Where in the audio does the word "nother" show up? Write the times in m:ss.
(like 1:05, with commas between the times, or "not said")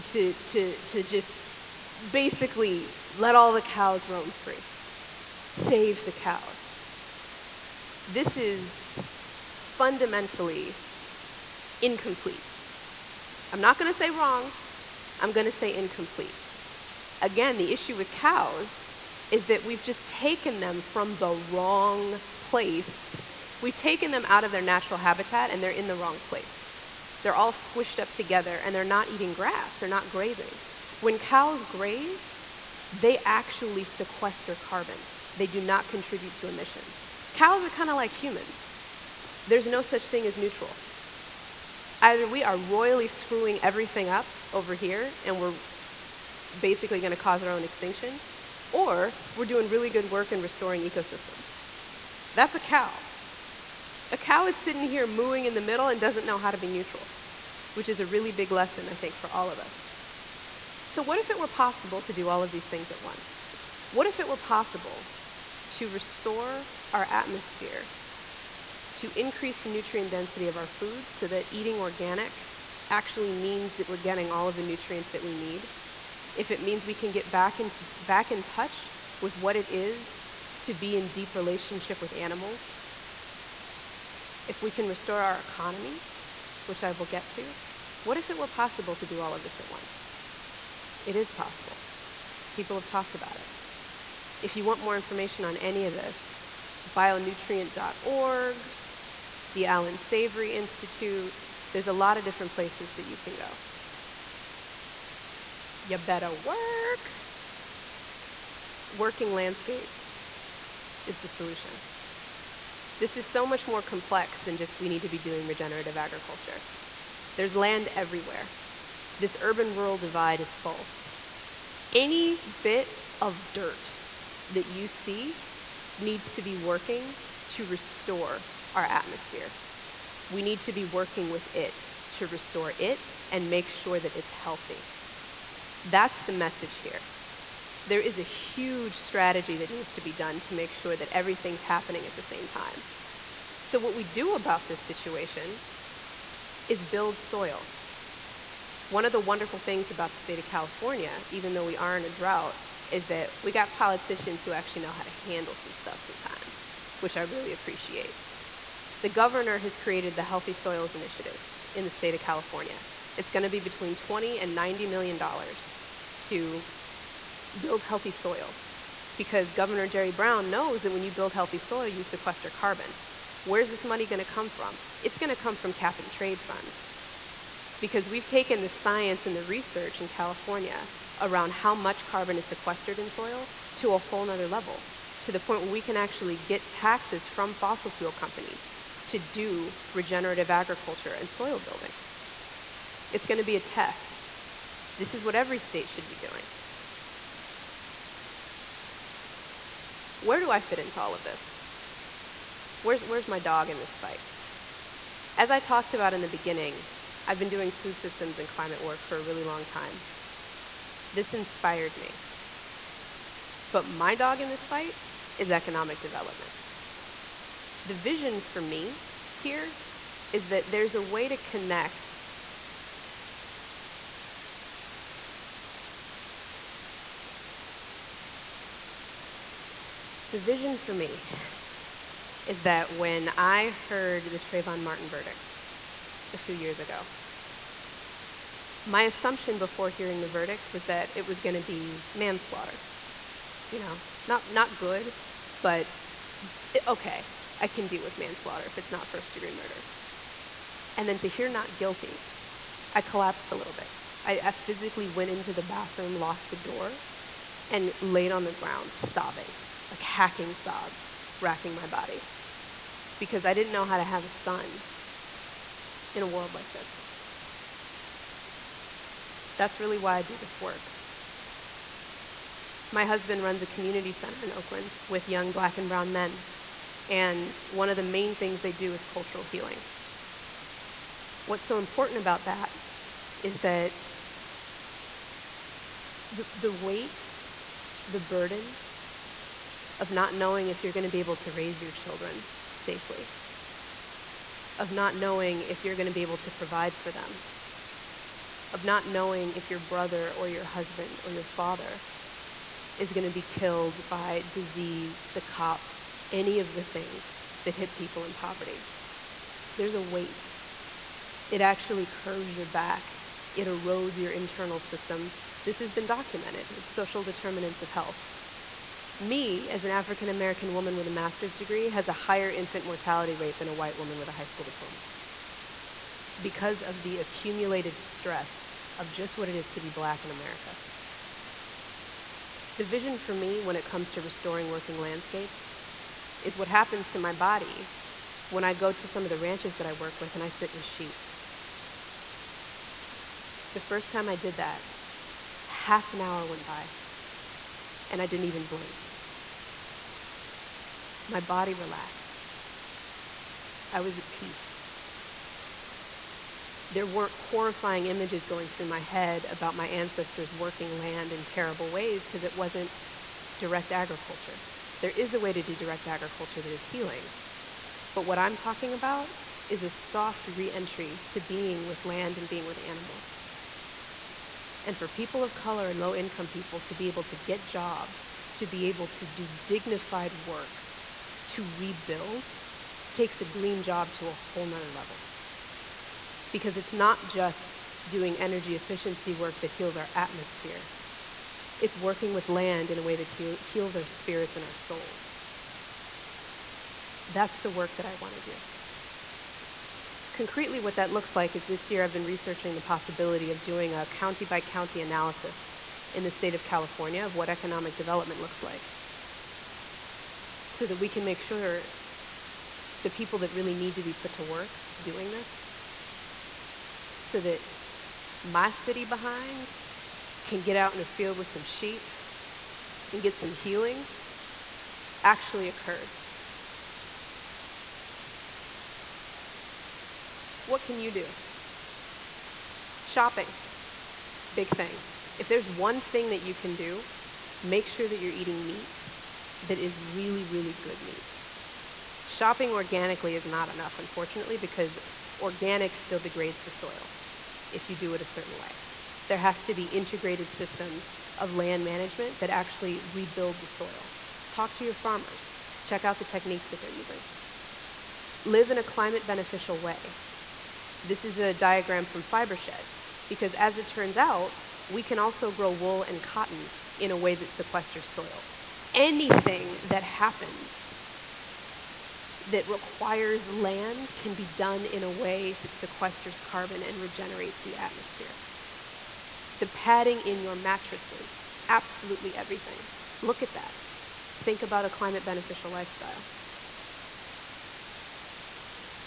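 3:04, 6:24.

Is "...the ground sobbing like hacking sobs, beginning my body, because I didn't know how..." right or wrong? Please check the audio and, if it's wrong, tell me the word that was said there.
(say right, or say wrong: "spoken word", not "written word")
wrong: "racking", not "beginning".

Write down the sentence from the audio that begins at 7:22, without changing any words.
Shopping organically is not enough, unfortunately, because organic still degrades the soil if you do it a certain way.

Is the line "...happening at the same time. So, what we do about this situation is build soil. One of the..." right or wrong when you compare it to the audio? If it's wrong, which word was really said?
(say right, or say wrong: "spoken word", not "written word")
right.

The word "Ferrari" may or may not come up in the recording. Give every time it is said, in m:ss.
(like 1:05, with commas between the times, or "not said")
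not said.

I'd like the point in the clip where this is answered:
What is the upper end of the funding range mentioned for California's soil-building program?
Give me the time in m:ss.
2:44.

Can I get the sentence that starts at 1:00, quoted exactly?
So, what if it were possible to do all of these things at once?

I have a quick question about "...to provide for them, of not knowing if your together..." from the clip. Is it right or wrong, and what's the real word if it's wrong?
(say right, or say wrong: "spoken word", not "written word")
wrong: "brother", not "together".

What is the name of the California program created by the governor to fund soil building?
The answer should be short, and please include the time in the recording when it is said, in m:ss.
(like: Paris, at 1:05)
Healthy Soils Initiative, at 2:40.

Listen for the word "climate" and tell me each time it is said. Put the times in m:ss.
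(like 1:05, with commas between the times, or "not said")
3:28, 7:38, 8:04.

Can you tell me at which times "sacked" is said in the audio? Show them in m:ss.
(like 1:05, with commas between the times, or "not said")
not said.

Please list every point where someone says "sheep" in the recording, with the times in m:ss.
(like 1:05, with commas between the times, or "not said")
5:40, 7:01.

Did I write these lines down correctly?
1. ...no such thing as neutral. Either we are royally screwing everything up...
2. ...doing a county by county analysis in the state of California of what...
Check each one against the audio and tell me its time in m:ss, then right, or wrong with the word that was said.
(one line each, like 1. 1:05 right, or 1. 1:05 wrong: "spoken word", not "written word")
1. 0:39 right
2. 6:43 right.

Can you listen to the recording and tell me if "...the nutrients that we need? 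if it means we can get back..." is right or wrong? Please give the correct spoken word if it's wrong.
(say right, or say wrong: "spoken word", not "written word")
right.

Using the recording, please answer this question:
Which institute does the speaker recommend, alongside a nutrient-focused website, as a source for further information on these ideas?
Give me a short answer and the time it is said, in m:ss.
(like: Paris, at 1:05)
Allan Savory Institute, at 1:39.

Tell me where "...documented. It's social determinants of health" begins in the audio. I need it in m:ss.
5:16.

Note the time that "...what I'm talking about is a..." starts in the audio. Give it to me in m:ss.
6:08.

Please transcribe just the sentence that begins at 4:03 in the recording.
You know, not, not good, but okay, I can deal with manslaughter if it's not first degree murder.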